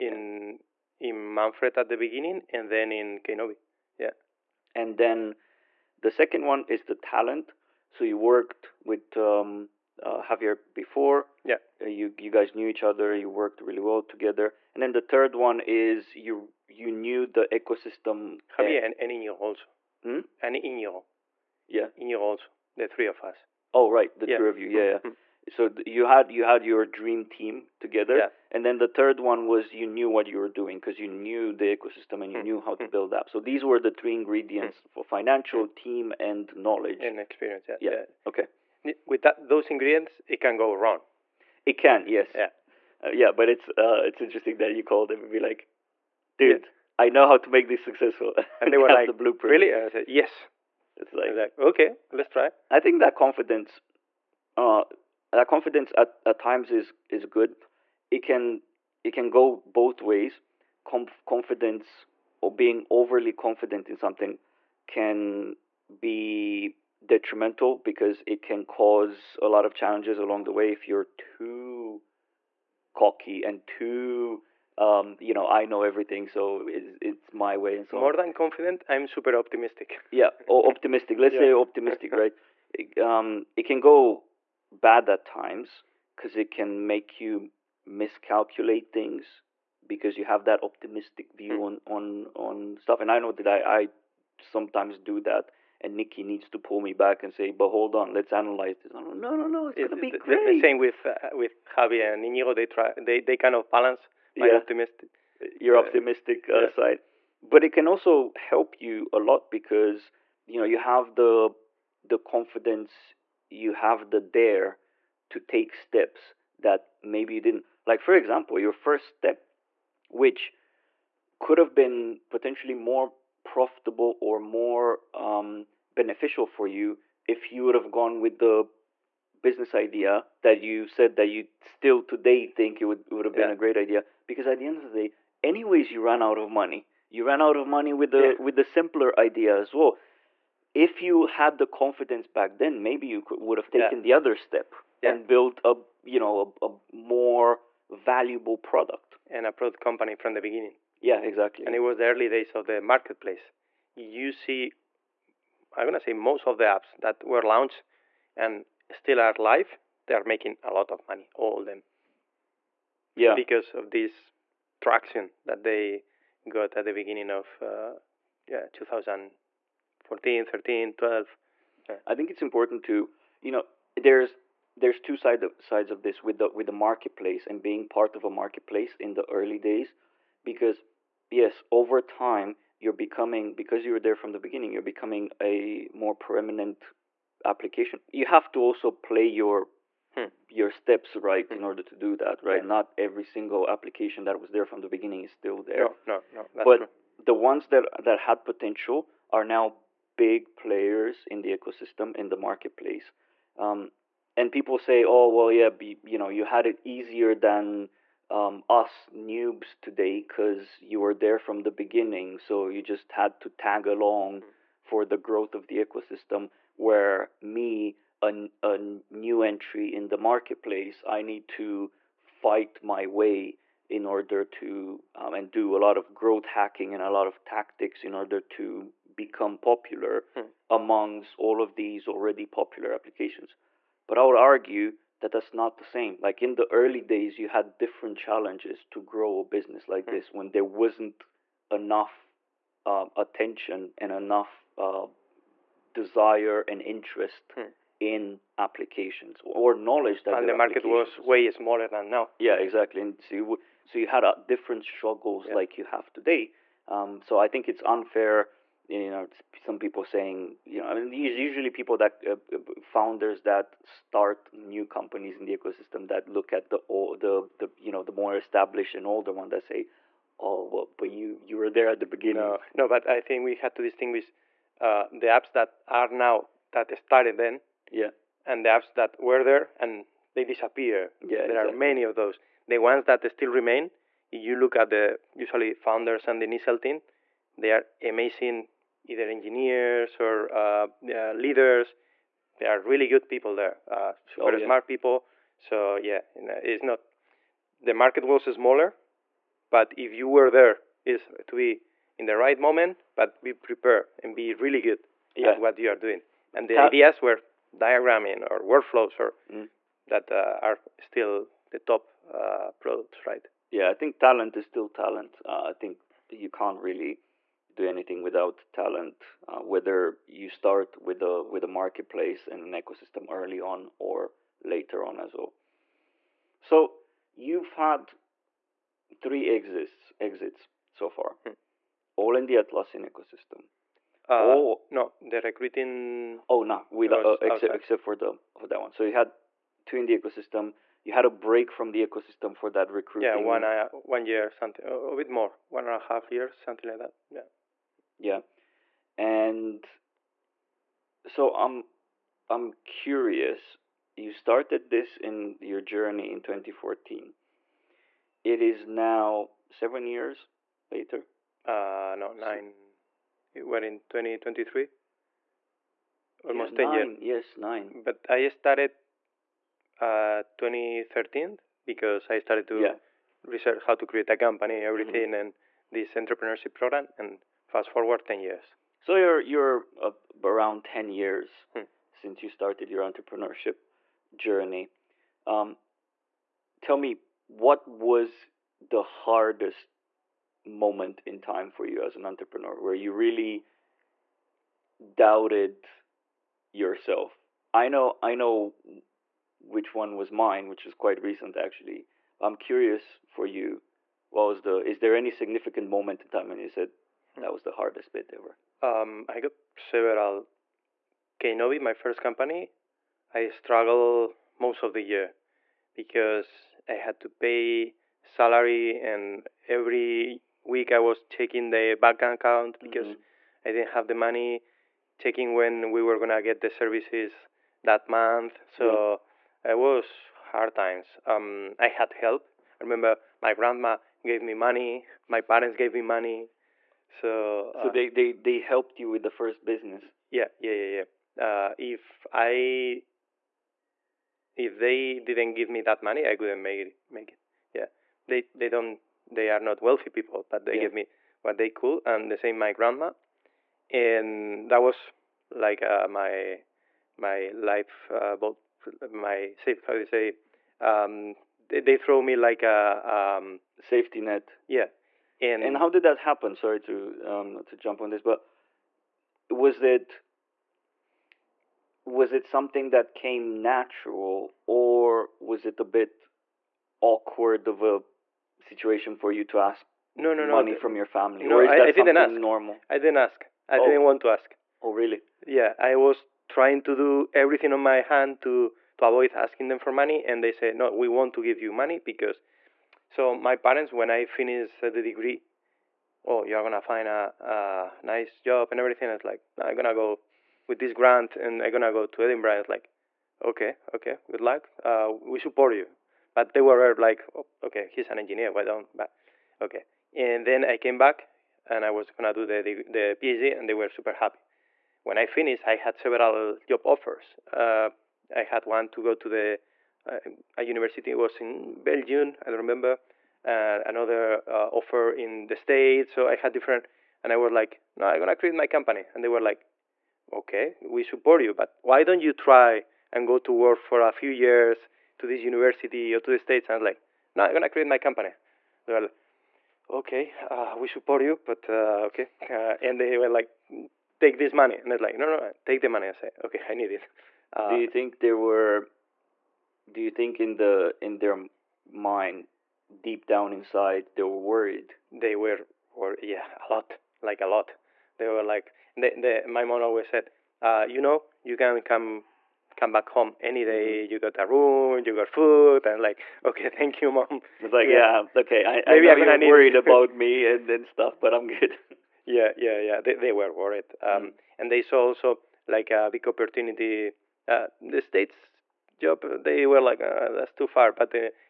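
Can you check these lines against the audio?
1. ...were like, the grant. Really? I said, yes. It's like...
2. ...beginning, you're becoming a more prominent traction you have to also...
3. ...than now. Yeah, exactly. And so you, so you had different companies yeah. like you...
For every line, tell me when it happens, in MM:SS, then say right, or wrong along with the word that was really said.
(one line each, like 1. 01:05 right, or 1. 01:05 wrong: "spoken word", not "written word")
1. 00:48 wrong: "blueprint", not "grant"
2. 03:04 wrong: "application", not "traction"
3. 04:11 wrong: "struggles", not "companies".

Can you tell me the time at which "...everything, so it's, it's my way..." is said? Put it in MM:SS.
01:15.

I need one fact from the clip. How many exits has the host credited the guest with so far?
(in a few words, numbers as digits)
3.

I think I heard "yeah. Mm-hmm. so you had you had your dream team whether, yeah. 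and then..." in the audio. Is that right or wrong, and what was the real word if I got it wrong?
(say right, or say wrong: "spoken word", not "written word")
wrong: "together", not "whether".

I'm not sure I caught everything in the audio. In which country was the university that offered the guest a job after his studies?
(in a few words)
Belgium.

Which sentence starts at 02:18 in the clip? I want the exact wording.
with the simpler idea as well if you had the confidence back then maybe you could, would have taken yeah.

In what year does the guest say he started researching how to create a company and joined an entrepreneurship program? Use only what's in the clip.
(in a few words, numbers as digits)
2013.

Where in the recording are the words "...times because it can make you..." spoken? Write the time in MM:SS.
01:25.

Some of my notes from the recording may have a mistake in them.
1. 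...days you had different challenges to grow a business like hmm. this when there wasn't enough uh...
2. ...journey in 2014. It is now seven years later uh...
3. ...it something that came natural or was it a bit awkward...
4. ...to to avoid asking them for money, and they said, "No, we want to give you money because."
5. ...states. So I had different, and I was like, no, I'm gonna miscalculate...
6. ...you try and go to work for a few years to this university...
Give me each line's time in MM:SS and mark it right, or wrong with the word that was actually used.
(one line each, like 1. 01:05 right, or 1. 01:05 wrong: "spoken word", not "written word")
1. 03:57 right
2. 05:55 right
3. 07:52 right
4. 08:08 right
5. 08:45 wrong: "create", not "miscalculate"
6. 08:52 right.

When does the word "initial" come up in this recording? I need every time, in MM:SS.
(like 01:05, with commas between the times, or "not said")
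04:46.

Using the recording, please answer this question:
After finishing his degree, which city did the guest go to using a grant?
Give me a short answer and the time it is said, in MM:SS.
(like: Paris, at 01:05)
Edinburgh, at 08:22.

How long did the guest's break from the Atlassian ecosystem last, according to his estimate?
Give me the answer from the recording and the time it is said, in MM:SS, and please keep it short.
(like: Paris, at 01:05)
One and a half years, at 05:45.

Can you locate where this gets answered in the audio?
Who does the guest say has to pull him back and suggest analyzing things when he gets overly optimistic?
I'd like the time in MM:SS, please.
01:35.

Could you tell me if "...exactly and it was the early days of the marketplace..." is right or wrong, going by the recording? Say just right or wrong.
right.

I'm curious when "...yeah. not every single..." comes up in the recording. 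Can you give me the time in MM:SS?
03:12.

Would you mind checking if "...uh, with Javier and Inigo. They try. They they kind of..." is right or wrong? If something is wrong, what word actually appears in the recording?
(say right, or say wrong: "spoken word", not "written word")
right.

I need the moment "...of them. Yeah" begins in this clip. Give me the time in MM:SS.
02:41.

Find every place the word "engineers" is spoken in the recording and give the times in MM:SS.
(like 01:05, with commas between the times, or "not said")
04:49, 08:28.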